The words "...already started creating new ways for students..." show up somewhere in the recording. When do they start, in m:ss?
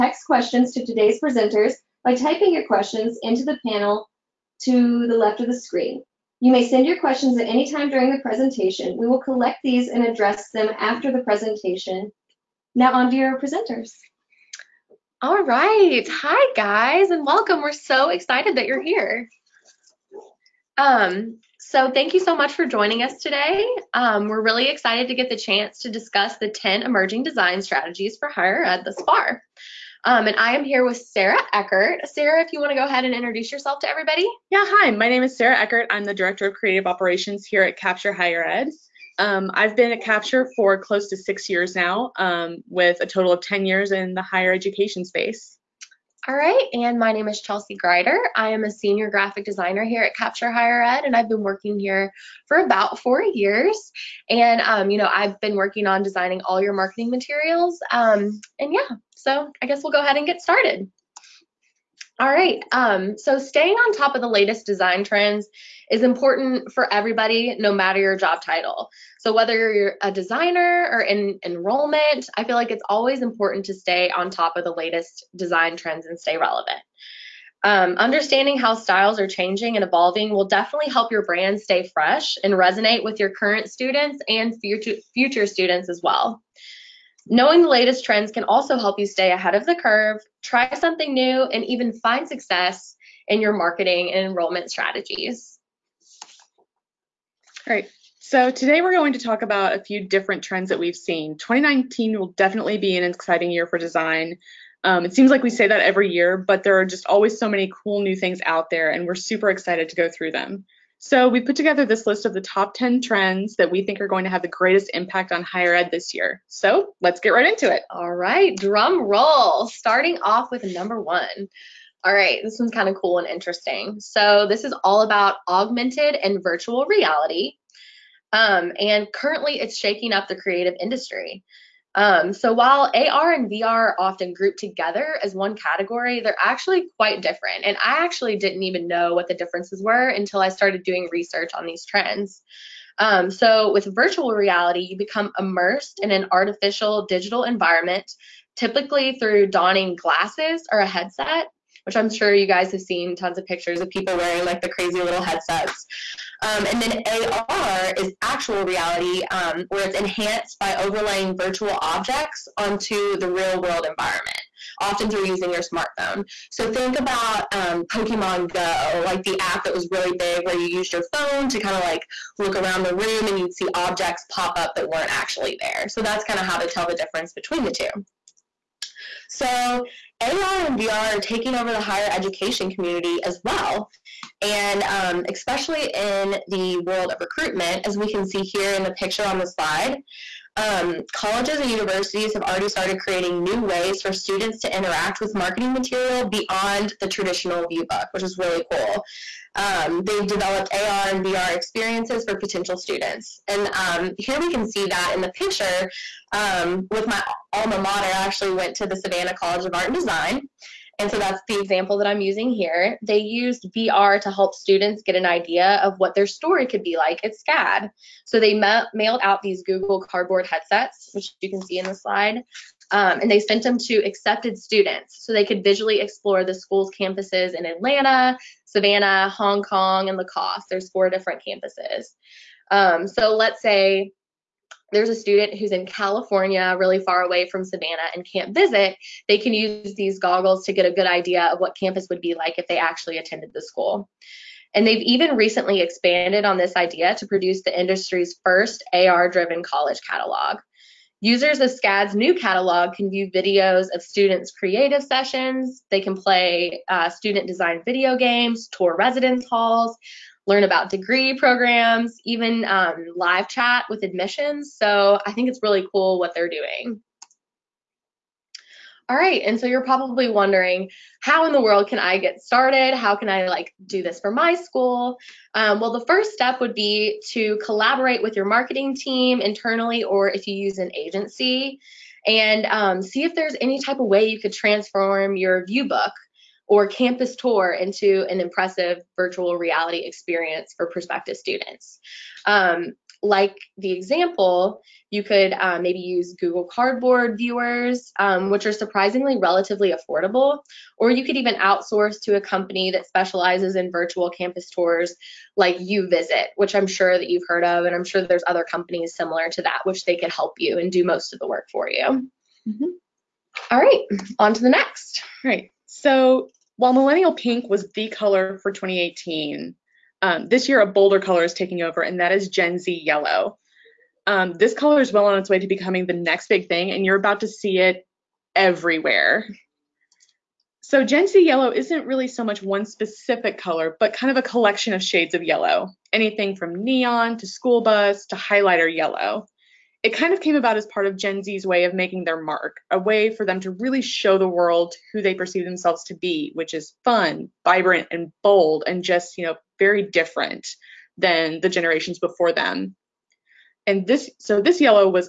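3:12.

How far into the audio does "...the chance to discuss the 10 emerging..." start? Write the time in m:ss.
0:25.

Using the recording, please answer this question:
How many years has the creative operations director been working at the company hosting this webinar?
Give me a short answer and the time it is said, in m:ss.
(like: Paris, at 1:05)
close to 6 years, at 0:40.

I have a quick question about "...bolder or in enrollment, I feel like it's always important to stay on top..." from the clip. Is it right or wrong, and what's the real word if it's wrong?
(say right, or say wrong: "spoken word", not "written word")
wrong: "designer", not "bolder".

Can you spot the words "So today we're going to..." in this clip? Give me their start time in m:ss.
1:38.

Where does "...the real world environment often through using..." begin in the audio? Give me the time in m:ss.
2:43.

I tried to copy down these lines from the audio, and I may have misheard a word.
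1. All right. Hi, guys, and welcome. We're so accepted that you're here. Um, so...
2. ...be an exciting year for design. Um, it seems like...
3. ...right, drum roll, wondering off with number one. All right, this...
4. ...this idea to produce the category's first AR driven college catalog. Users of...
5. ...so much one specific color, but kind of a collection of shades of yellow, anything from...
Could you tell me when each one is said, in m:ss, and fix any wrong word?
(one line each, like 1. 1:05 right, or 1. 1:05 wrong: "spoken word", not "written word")
1. 0:15 wrong: "excited", not "accepted"
2. 1:42 right
3. 1:58 wrong: "starting", not "wondering"
4. 4:06 wrong: "industry", not "category"
5. 5:32 right.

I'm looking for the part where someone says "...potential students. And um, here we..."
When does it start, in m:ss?
3:22.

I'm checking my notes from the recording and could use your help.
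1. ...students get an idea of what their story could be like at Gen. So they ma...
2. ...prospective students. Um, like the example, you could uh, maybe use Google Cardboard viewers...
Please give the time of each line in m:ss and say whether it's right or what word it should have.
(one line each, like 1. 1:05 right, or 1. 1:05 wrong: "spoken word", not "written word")
1. 3:34 wrong: "SCAD", not "Gen"
2. 4:50 right.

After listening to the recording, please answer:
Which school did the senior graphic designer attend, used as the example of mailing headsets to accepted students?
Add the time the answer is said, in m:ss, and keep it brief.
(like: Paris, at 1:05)
Savannah College of Art and Design, at 3:28.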